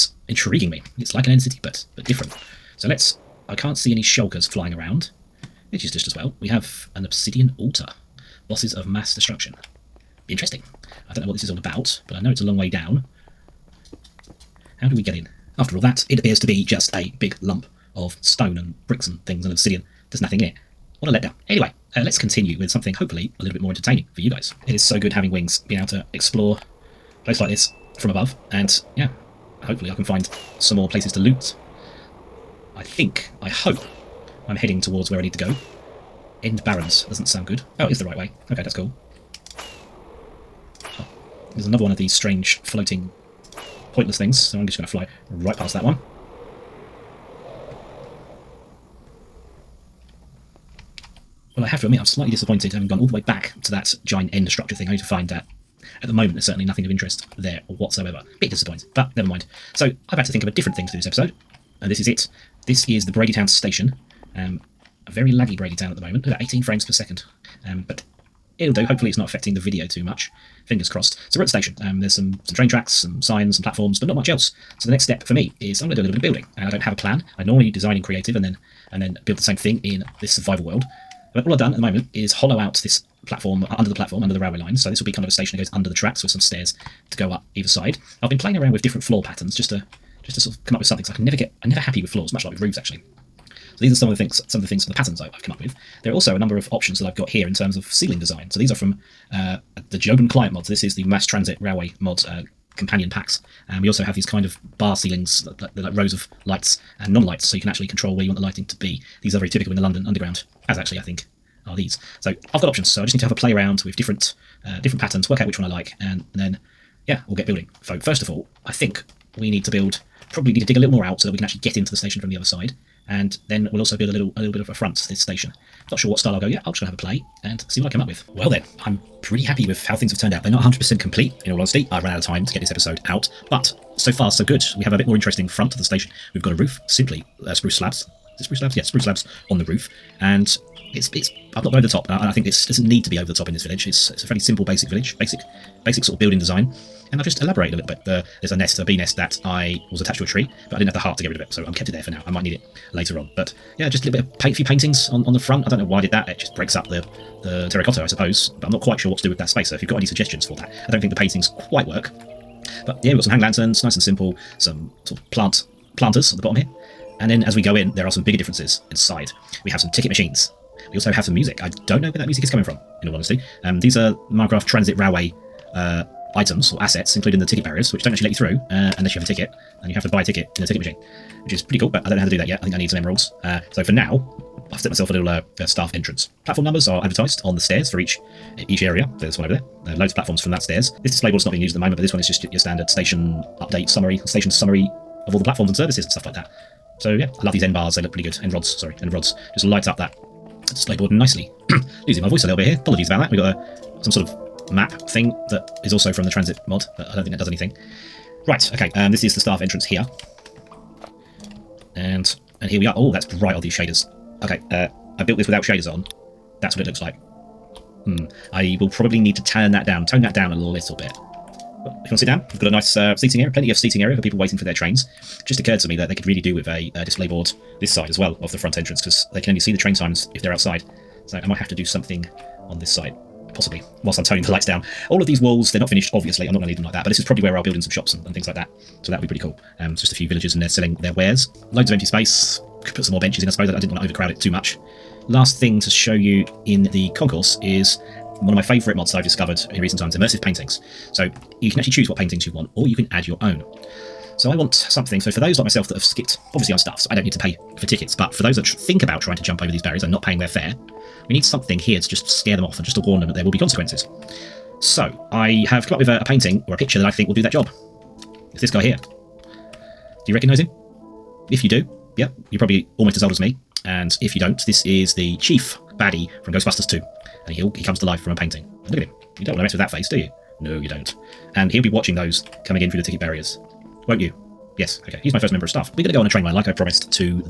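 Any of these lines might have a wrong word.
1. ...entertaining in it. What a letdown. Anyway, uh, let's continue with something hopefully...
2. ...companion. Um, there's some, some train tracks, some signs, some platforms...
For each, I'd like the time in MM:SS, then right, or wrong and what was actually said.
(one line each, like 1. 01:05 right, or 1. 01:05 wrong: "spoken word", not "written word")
1. 00:20 wrong: "nothing", not "entertaining"
2. 01:11 wrong: "station", not "companion".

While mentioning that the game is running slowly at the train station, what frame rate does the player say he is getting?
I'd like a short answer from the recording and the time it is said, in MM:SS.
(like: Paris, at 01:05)
18 frames per second, at 01:06.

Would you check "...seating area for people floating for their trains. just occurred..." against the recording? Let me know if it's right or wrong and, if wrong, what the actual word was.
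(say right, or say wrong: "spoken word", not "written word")
wrong: "waiting", not "floating".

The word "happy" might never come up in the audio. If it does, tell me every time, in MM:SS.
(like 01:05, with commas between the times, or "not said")
01:31, 02:09.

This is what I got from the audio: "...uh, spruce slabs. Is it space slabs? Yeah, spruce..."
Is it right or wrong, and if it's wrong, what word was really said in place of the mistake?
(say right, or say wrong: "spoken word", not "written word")
wrong: "spruce", not "space".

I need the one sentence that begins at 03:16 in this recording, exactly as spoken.
So yeah, I love these end bars.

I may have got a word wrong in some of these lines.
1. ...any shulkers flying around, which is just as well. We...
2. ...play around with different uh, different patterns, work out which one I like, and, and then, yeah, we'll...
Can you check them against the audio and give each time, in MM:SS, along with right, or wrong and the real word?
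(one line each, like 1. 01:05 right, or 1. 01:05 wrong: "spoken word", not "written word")
1. 00:03 right
2. 01:53 right.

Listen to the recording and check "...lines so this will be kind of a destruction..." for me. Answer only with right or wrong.
wrong.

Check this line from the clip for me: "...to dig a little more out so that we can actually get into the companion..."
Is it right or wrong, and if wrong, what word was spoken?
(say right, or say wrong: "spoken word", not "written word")
wrong: "station", not "companion".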